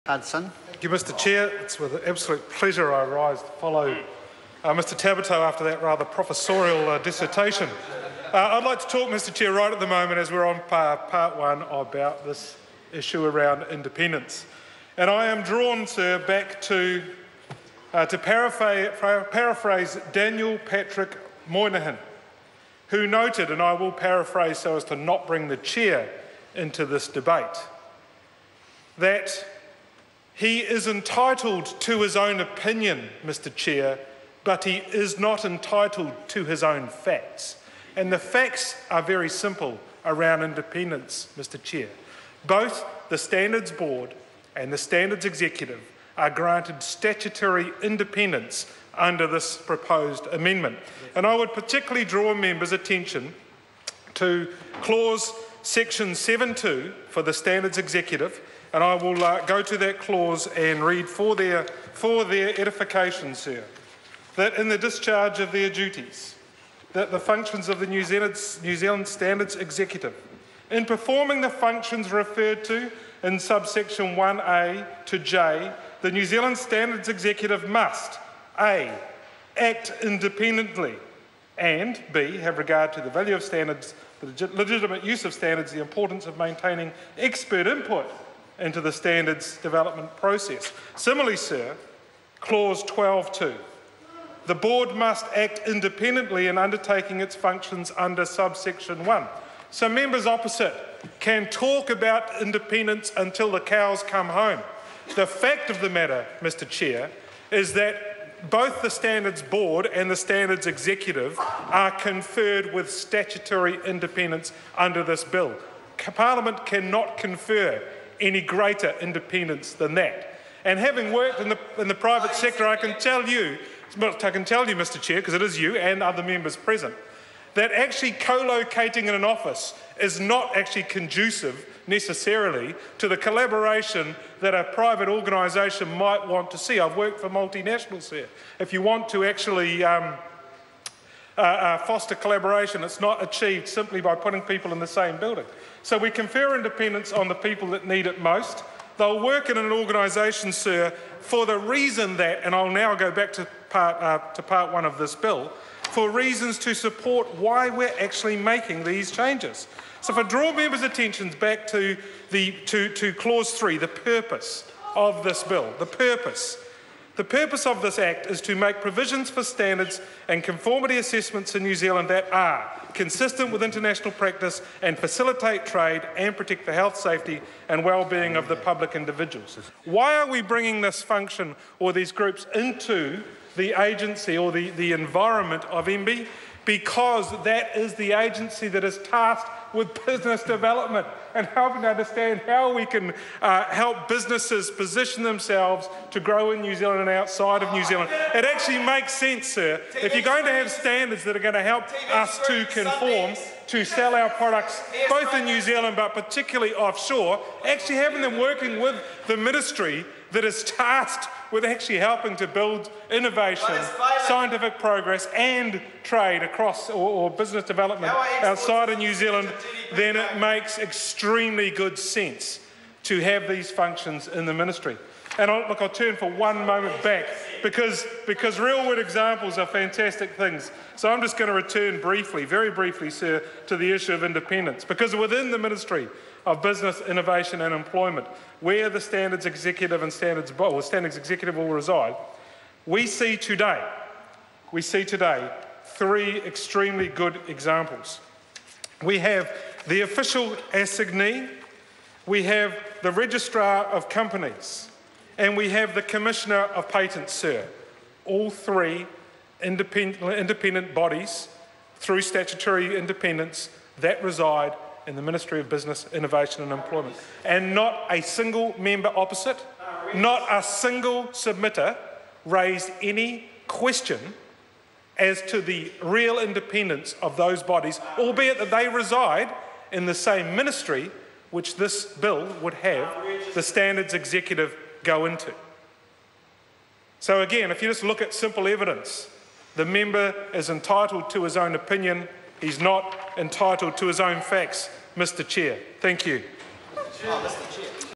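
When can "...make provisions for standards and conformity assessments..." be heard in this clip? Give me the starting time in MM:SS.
02:48.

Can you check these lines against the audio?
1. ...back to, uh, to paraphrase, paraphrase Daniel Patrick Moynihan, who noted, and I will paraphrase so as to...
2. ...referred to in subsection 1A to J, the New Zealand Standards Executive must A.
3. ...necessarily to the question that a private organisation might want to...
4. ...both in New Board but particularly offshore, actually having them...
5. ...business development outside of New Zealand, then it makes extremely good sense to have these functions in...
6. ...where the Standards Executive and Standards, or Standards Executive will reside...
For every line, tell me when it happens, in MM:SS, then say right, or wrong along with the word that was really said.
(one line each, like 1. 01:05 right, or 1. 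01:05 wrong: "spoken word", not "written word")
1. 00:16 right
2. 01:12 right
3. 02:11 wrong: "collaboration", not "question"
4. 03:25 wrong: "Zealand", not "Board"
5. 03:37 right
6. 03:58 right.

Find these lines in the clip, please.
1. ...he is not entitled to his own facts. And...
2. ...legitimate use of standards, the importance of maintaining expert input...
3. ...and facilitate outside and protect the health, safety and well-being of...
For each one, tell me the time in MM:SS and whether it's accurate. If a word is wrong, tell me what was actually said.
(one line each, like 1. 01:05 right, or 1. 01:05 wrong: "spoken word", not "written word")
1. 00:34 right
2. 01:24 right
3. 02:54 wrong: "trade", not "outside".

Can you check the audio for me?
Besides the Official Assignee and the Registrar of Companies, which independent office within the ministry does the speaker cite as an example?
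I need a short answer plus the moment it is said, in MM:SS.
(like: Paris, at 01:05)
Commissioner of Patents, at 04:16.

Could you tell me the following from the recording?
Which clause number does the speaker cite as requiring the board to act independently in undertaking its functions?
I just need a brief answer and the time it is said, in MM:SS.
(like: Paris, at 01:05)
12.2, at 01:32.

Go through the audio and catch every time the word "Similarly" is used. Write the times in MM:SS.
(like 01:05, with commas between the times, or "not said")
01:30.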